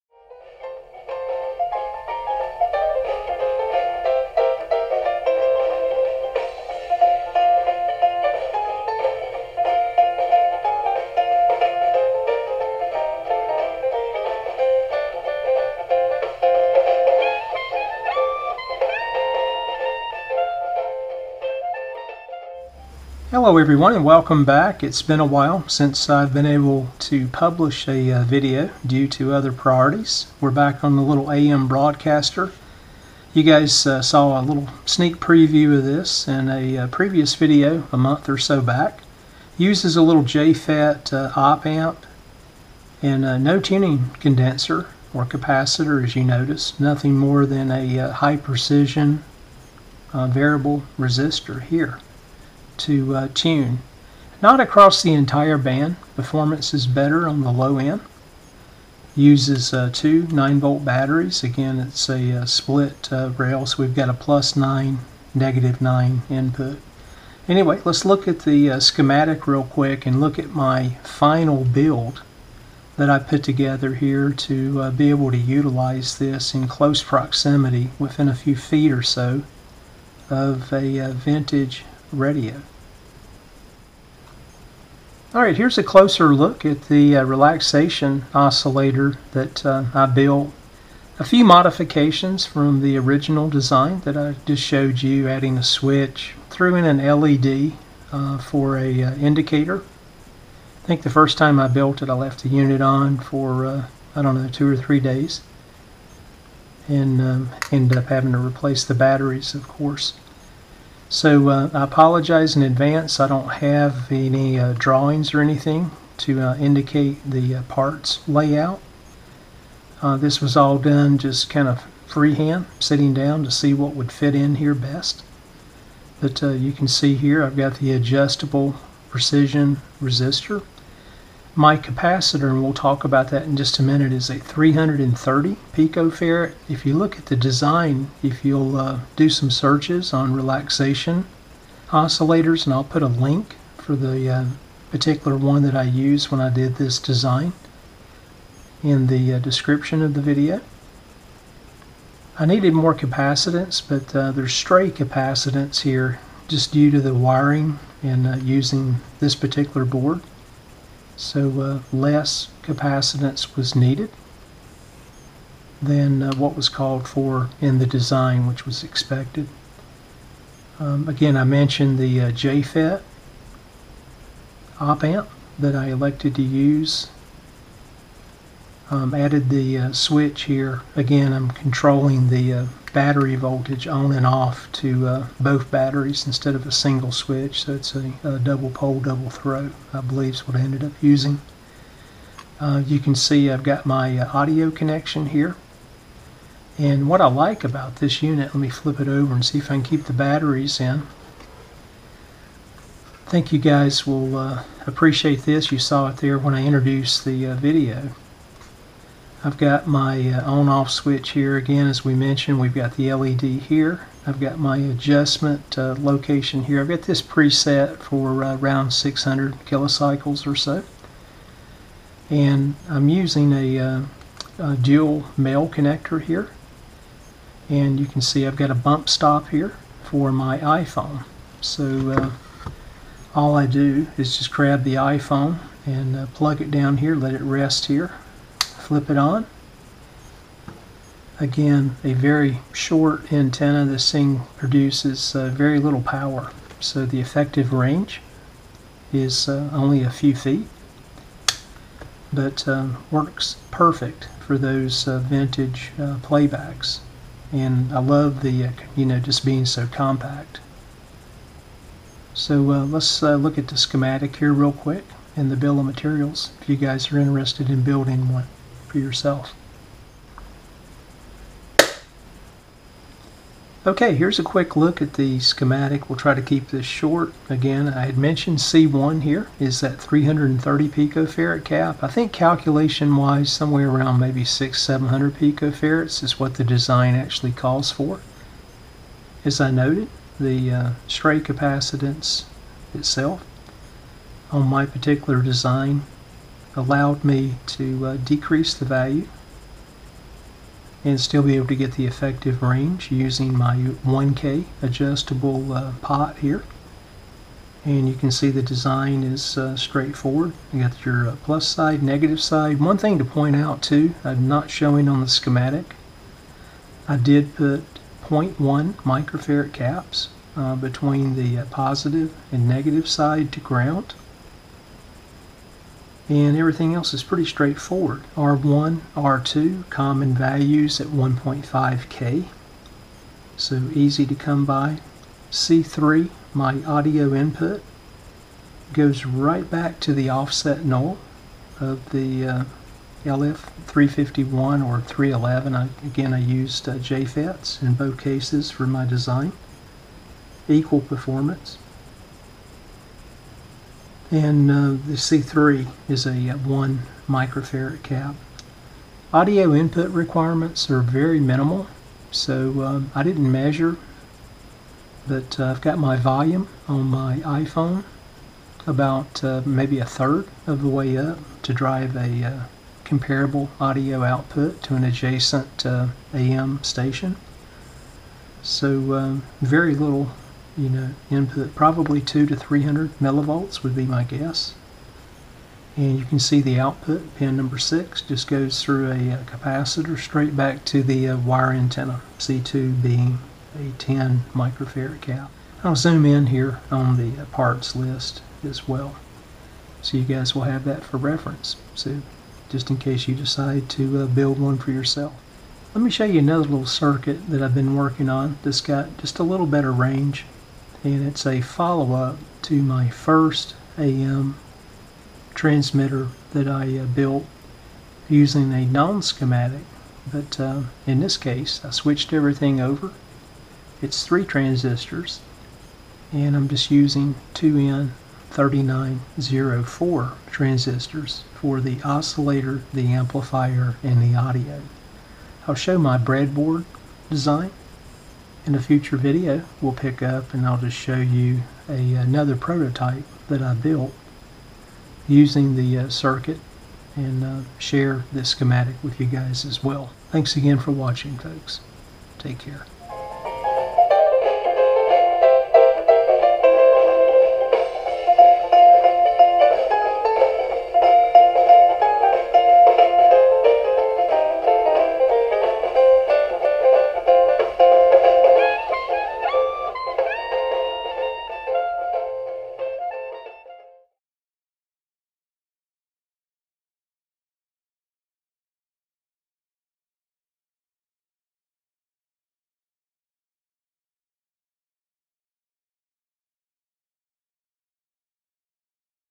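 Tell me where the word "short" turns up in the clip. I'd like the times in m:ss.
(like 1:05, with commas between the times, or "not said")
4:02, 4:36.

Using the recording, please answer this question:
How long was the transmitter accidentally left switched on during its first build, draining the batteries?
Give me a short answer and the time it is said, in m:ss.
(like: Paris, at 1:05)
two or three days, at 1:44.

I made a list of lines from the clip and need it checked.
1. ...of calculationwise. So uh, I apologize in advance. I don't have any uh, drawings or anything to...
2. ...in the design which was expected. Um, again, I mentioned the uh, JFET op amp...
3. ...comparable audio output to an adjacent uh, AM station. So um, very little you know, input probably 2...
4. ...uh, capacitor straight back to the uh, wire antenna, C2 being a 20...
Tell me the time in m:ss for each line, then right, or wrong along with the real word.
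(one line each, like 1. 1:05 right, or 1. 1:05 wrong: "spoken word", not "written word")
1. 1:49 wrong: "course", not "calculationwise"
2. 2:47 right
3. 6:13 right
4. 6:29 wrong: "10", not "20".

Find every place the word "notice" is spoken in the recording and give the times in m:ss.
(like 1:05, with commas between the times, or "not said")
0:46.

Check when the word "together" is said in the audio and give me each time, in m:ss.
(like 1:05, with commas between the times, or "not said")
1:13.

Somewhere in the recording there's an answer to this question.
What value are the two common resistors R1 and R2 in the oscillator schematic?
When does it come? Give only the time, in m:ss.
5:31.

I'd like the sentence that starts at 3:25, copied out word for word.
You saw it there when I introduced the uh, video.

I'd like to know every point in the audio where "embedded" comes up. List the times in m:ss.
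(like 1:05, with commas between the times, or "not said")
not said.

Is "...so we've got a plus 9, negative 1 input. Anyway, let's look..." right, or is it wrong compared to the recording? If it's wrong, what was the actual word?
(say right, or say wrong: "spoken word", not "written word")
wrong: "9", not "1".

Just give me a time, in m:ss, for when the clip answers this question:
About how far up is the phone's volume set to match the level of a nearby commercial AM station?
6:09.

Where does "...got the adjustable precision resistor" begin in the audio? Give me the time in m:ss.
2:07.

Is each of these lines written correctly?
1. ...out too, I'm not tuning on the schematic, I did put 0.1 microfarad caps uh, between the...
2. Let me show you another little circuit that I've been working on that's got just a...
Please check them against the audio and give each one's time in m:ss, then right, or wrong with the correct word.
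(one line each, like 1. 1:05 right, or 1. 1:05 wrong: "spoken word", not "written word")
1. 5:13 wrong: "showing", not "tuning"
2. 6:45 right.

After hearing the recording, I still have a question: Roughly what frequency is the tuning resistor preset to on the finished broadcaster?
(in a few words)
600 kilocycles.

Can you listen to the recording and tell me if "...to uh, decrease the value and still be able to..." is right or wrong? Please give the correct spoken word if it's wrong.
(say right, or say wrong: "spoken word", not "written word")
right.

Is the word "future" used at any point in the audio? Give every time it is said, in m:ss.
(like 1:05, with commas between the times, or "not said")
7:18.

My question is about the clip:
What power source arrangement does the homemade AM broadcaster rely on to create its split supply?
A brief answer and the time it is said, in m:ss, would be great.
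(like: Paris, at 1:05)
two 9 volt batteries, at 0:59.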